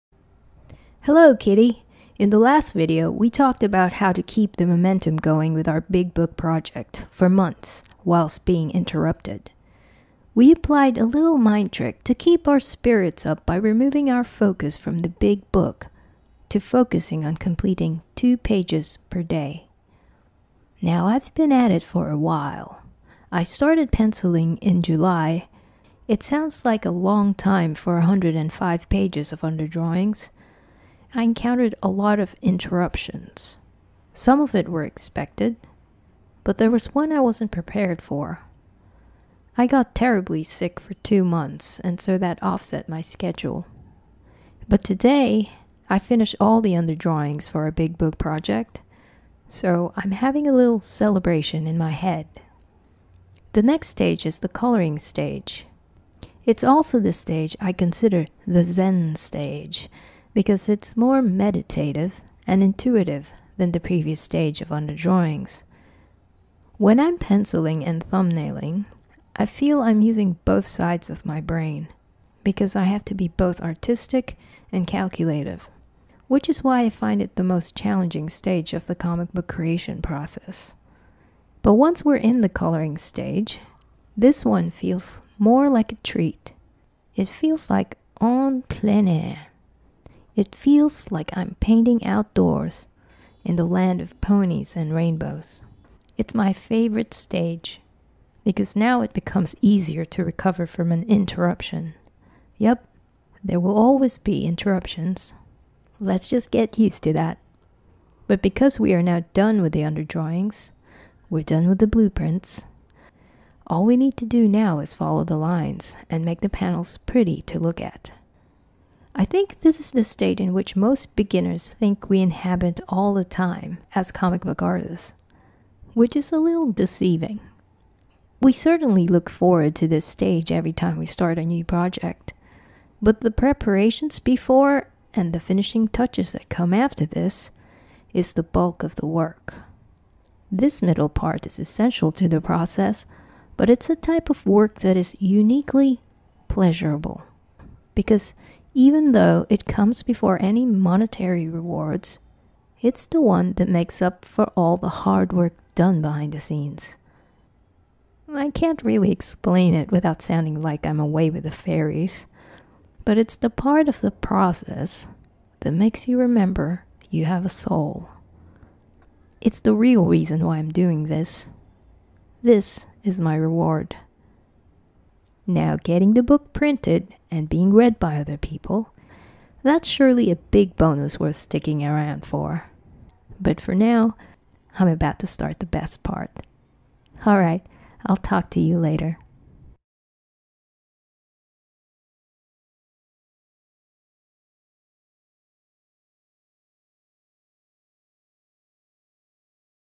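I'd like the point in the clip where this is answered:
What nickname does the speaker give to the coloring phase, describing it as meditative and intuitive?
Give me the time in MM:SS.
00:58.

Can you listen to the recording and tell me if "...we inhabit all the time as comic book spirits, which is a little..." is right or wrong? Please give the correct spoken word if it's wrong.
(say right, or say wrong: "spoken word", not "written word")
wrong: "artists", not "spirits".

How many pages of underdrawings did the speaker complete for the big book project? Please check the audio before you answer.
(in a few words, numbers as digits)
105.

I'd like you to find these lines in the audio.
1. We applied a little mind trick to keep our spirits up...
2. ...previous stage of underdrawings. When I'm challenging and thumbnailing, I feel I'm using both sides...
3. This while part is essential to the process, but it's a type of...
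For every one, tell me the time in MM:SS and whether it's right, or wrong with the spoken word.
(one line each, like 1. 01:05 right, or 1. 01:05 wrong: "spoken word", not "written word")
1. 00:10 right
2. 01:03 wrong: "penciling", not "challenging"
3. 02:20 wrong: "middle", not "while".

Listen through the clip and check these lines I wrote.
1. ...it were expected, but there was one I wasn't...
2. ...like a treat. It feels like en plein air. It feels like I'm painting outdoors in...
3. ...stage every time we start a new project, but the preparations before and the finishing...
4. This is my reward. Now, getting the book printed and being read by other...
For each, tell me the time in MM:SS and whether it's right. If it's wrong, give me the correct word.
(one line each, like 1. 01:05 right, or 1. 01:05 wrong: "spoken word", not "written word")
1. 00:34 right
2. 01:25 right
3. 02:10 right
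4. 02:52 right.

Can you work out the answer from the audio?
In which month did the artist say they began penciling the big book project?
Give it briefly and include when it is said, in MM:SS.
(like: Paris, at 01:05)
July, at 00:24.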